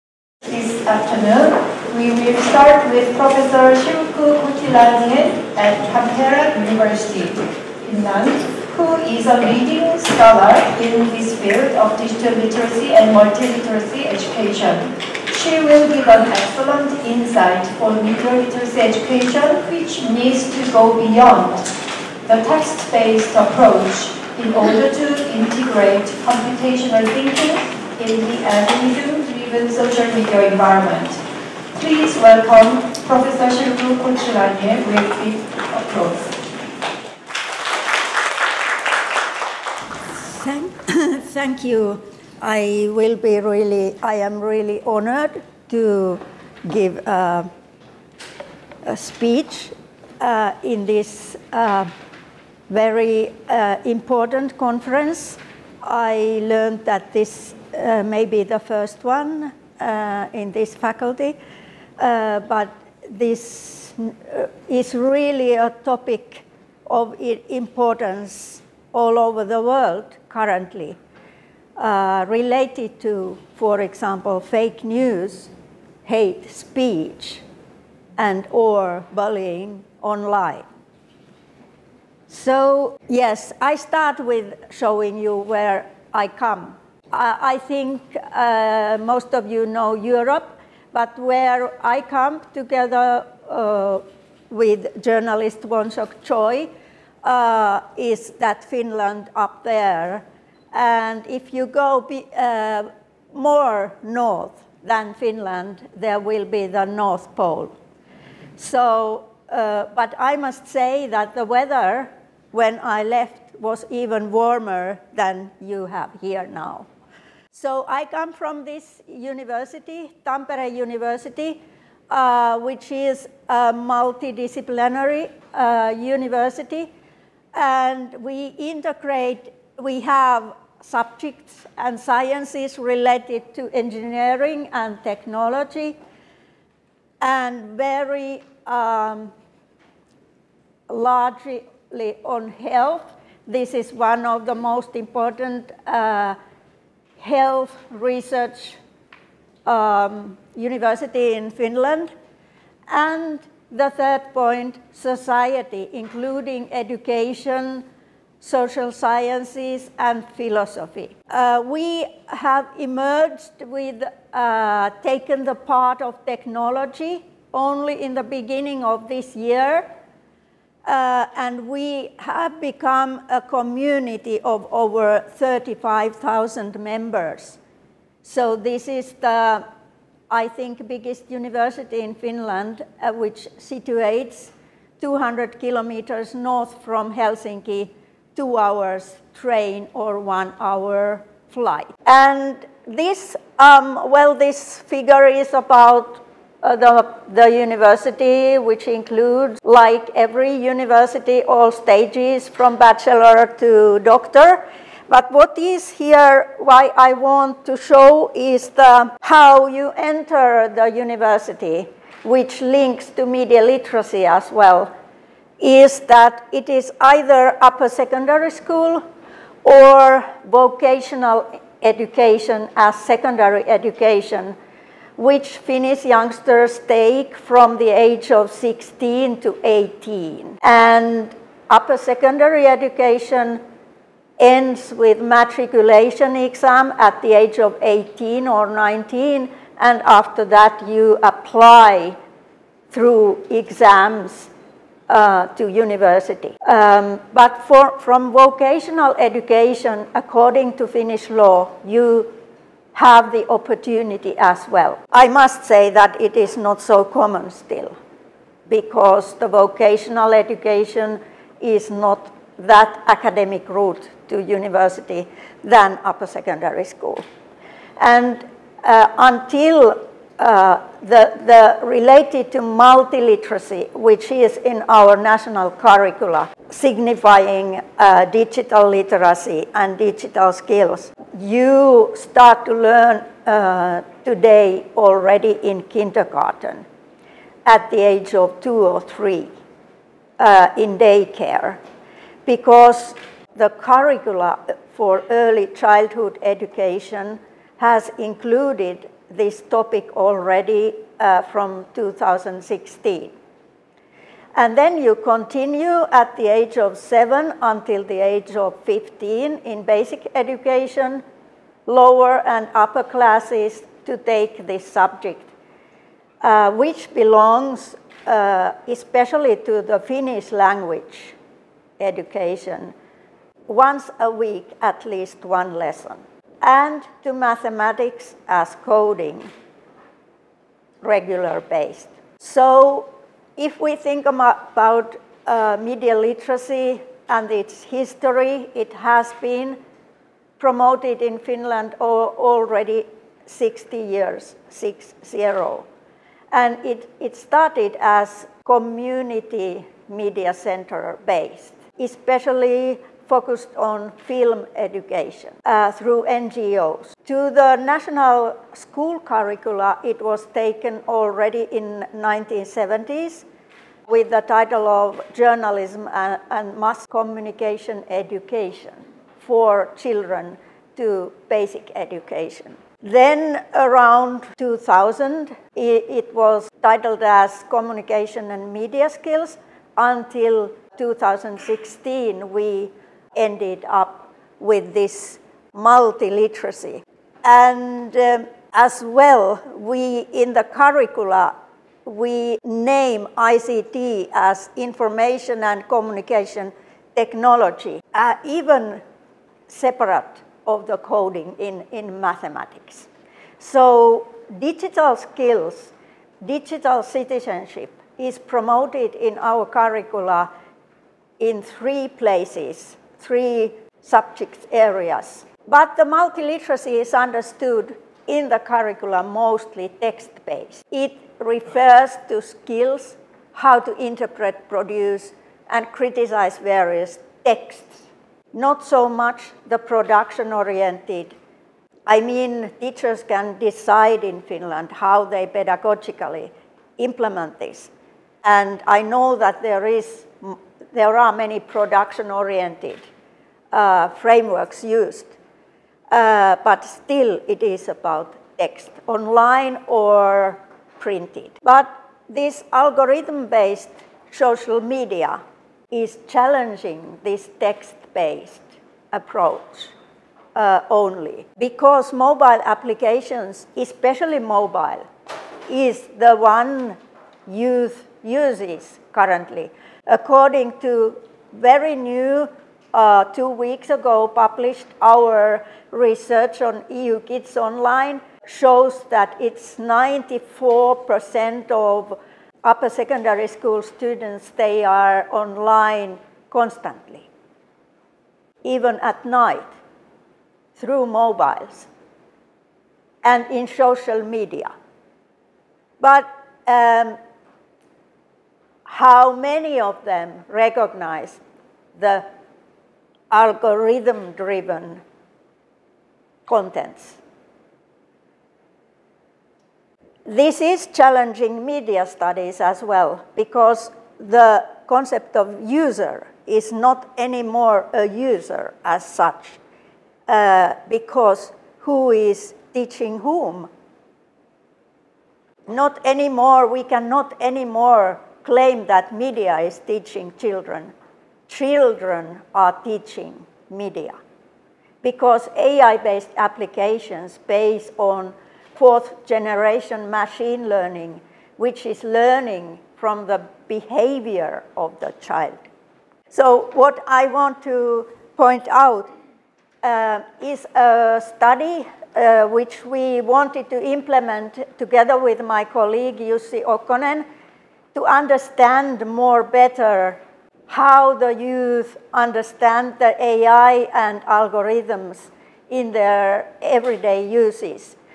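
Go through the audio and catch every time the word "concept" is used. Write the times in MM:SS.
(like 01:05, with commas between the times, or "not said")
08:34.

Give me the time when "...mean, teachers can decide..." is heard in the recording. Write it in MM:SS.
07:12.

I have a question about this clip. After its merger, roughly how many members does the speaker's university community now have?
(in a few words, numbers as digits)
over 35,000.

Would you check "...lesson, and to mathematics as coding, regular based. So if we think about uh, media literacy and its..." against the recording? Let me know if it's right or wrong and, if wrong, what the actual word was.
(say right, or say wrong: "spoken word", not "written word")
right.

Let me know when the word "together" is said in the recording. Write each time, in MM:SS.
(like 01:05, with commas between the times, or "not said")
01:32, 09:14.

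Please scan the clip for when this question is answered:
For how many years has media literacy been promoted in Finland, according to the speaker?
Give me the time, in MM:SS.
05:43.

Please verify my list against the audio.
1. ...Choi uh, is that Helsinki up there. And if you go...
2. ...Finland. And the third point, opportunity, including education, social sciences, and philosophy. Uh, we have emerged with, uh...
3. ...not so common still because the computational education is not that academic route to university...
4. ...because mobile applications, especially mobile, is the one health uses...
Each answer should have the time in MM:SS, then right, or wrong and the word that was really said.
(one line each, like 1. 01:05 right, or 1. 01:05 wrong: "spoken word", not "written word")
1. 01:36 wrong: "Finland", not "Helsinki"
2. 02:31 wrong: "society", not "opportunity"
3. 04:16 wrong: "vocational", not "computational"
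4. 07:41 wrong: "youth", not "health".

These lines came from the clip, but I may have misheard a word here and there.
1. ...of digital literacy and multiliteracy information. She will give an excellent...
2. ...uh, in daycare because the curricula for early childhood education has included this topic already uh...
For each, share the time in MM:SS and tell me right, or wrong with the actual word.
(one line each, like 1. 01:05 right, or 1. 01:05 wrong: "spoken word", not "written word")
1. 00:11 wrong: "education", not "information"
2. 04:50 right.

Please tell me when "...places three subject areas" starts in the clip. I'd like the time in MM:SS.
06:52.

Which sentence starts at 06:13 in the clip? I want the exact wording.
Then around 2000, it was titled as Communication and Media Skills until 2016 we ended up with this multiliteracy.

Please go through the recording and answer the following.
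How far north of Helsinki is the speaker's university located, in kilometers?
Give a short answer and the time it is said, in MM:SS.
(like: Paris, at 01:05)
200, at 03:04.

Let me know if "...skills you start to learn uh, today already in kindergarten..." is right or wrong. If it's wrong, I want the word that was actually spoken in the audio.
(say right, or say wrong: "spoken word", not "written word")
right.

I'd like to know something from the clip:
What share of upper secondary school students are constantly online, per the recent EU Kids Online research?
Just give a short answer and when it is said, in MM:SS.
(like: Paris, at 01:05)
94%, at 07:59.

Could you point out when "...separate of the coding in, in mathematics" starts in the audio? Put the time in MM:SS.
06:39.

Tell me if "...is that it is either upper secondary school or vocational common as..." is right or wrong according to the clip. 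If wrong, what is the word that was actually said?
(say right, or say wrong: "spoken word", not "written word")
wrong: "education", not "common".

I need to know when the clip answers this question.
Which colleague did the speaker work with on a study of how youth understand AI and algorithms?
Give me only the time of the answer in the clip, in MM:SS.
09:16.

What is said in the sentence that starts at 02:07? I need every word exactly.
And we integrate, we have subjects and sciences related to engineering and technology and very um, largely on health.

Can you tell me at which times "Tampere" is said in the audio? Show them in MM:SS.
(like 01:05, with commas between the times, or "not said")
00:05, 02:00.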